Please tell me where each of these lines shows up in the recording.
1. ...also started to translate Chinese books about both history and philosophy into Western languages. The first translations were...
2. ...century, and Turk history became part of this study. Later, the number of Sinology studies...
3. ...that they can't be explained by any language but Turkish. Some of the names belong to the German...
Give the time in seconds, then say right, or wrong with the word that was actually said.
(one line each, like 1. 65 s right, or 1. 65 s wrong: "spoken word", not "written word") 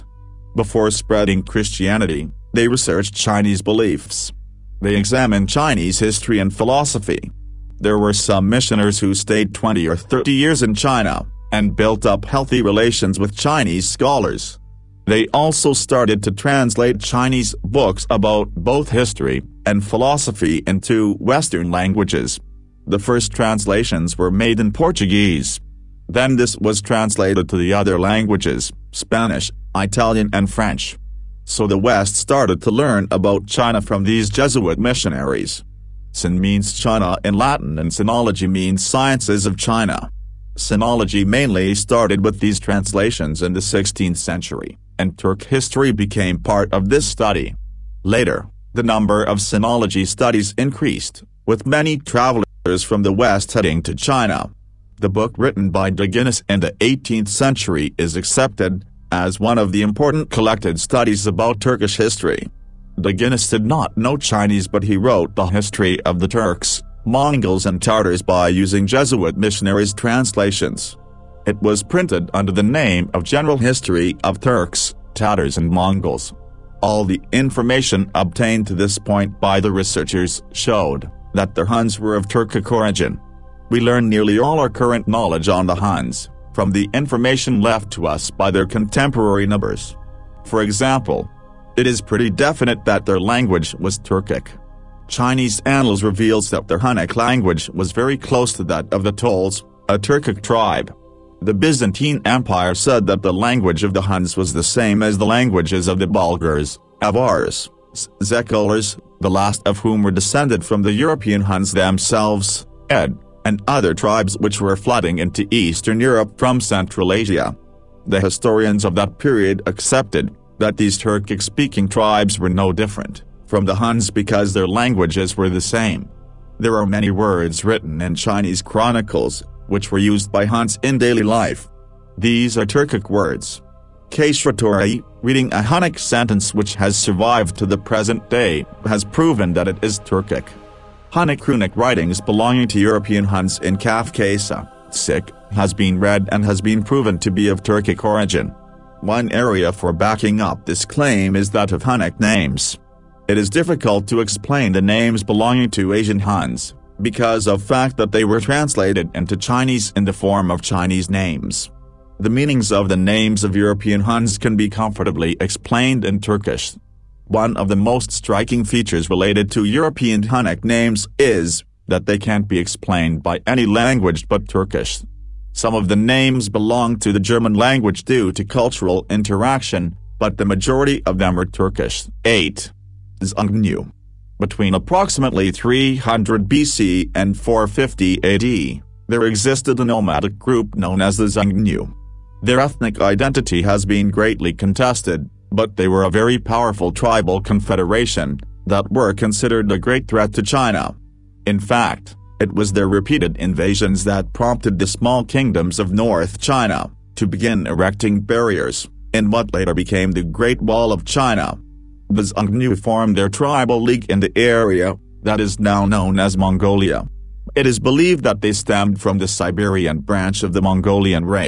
1. 15 s right
2. 44 s right
3. 171 s right.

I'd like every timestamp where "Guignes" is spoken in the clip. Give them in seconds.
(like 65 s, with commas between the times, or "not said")
56 s, 63 s.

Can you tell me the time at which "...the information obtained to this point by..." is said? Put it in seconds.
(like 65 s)
77 s.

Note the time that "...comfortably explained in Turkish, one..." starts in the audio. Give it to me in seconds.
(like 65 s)
164 s.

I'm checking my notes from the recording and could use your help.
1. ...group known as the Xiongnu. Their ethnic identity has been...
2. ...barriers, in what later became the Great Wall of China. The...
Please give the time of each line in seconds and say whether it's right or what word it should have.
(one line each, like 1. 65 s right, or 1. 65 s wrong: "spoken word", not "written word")
1. 190 s right
2. 208 s right.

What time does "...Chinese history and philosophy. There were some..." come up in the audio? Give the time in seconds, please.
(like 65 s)
5 s.